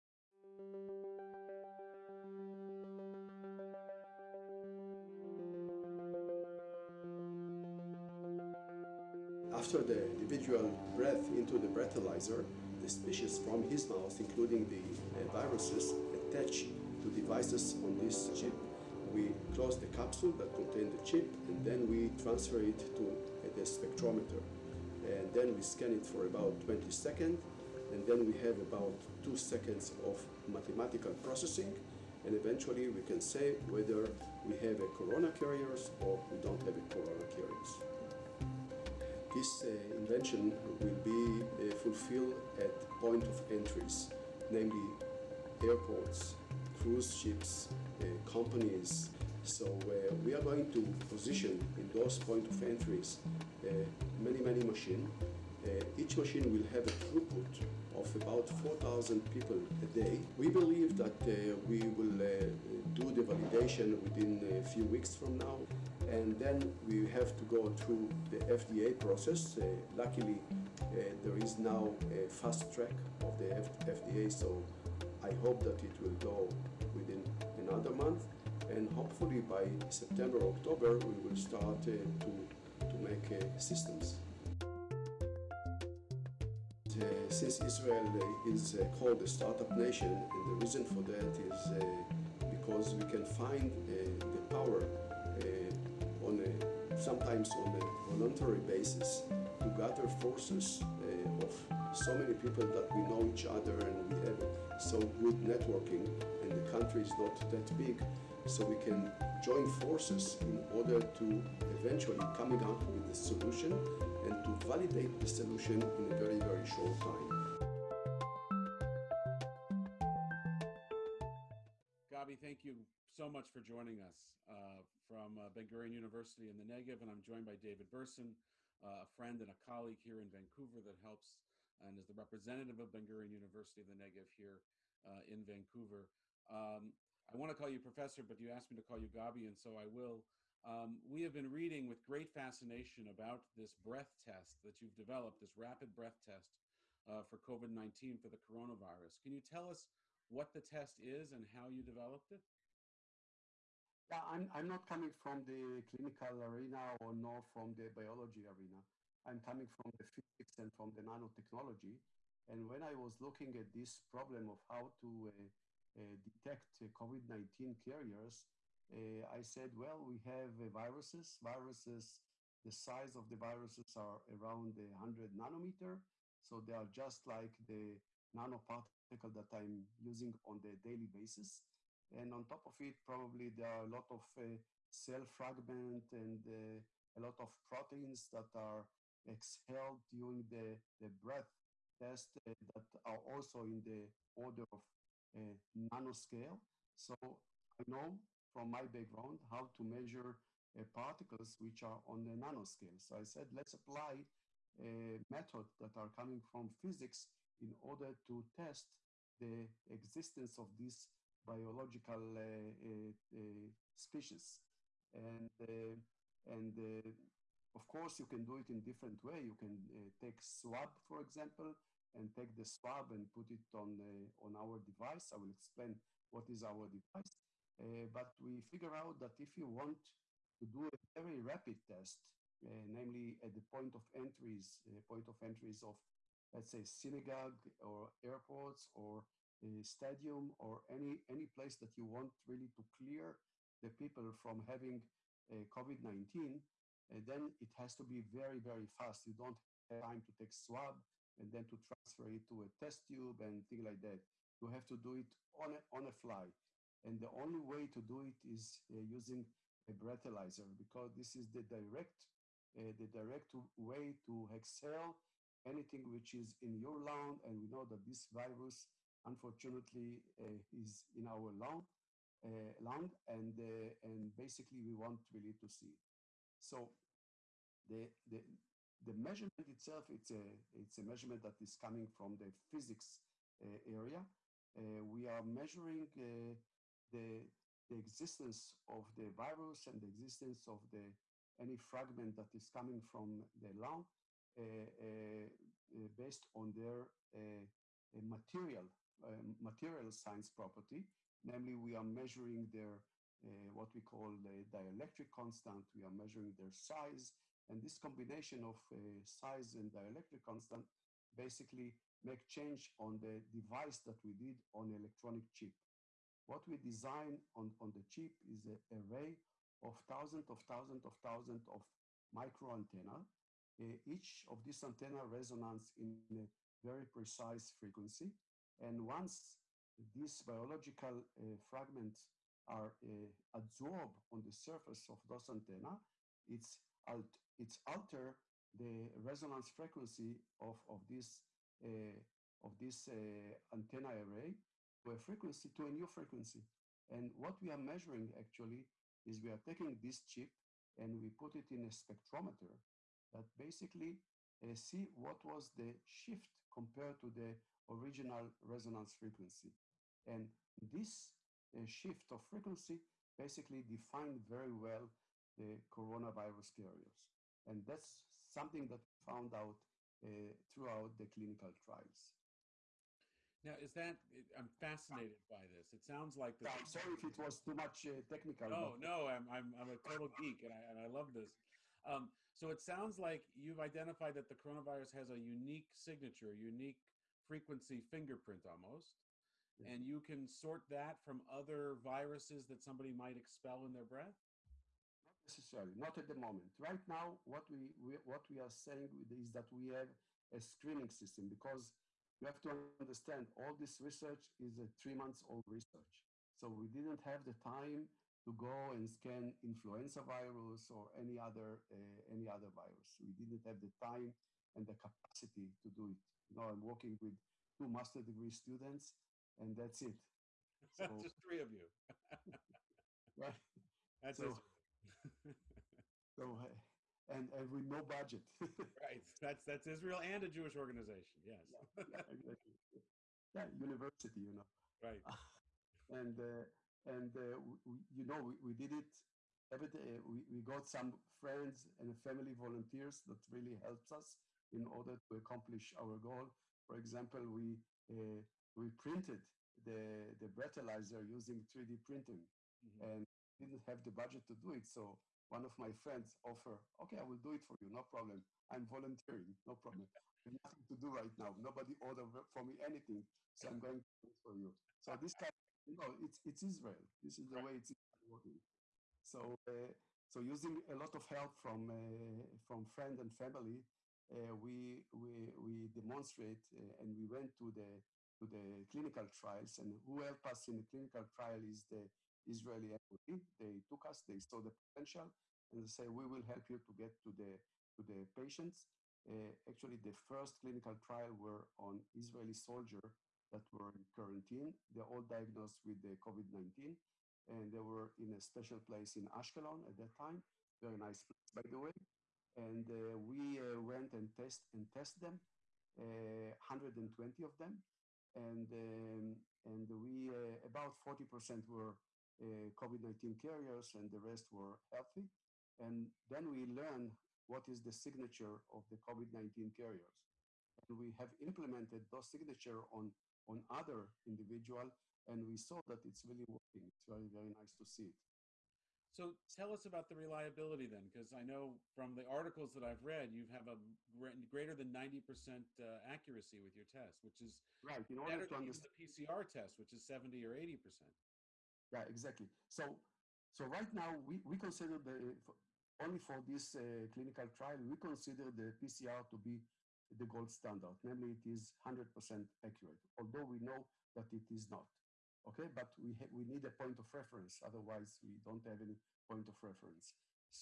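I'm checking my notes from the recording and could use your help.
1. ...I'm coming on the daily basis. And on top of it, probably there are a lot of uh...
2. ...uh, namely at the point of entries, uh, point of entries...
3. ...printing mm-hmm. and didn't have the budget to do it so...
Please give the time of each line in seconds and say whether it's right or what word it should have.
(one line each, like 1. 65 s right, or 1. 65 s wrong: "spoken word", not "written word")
1. 179 s wrong: "using", not "coming"
2. 232 s right
3. 452 s right.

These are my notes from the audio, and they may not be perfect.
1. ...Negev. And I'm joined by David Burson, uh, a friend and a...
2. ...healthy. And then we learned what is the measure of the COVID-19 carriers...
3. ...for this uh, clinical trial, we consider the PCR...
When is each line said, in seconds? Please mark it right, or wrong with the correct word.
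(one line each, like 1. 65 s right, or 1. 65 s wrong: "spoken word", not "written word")
1. 126 s right
2. 514 s wrong: "signature", not "measure"
3. 546 s right.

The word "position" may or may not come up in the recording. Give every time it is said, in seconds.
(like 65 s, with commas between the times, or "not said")
51 s.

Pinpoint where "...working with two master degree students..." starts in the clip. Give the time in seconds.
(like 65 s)
416 s.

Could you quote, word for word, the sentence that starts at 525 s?
And we saw that it's really working.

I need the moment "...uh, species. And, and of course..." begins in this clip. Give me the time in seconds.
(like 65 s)
213 s.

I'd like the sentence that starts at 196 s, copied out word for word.
So I know from my background how to measure uh, particles which are on the nanoscale.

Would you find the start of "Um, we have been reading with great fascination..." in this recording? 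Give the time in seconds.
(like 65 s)
140 s.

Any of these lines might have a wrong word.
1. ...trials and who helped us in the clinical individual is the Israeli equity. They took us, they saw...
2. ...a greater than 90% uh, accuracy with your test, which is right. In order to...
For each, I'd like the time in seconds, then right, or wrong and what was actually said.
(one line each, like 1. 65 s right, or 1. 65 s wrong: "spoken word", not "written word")
1. 479 s wrong: "trial", not "individual"
2. 533 s right.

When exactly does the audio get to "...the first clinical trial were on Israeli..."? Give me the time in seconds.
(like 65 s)
489 s.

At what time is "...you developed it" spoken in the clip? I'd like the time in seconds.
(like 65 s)
151 s.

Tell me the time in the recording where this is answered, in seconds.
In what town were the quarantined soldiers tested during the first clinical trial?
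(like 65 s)
499 s.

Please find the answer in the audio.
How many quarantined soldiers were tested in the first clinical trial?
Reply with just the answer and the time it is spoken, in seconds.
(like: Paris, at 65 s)
120, at 506 s.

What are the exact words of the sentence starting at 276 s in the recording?
So the, the, the measurement itself, it's a, it's a measurement that is coming from the physics uh, area.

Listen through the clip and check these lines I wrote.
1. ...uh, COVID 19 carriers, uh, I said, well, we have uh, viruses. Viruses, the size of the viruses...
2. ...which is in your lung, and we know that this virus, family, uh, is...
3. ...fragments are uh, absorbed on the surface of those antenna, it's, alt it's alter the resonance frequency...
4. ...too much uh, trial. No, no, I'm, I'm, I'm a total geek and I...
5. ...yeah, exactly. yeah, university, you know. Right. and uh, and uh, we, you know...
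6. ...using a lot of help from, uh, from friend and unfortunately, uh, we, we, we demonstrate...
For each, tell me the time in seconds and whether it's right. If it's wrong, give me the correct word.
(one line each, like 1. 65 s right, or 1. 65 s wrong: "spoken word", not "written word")
1. 166 s right
2. 266 s wrong: "unfortunately", not "family"
3. 331 s right
4. 377 s wrong: "technical", not "trial"
5. 432 s right
6. 470 s wrong: "family", not "unfortunately".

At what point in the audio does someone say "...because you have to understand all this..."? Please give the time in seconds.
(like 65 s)
401 s.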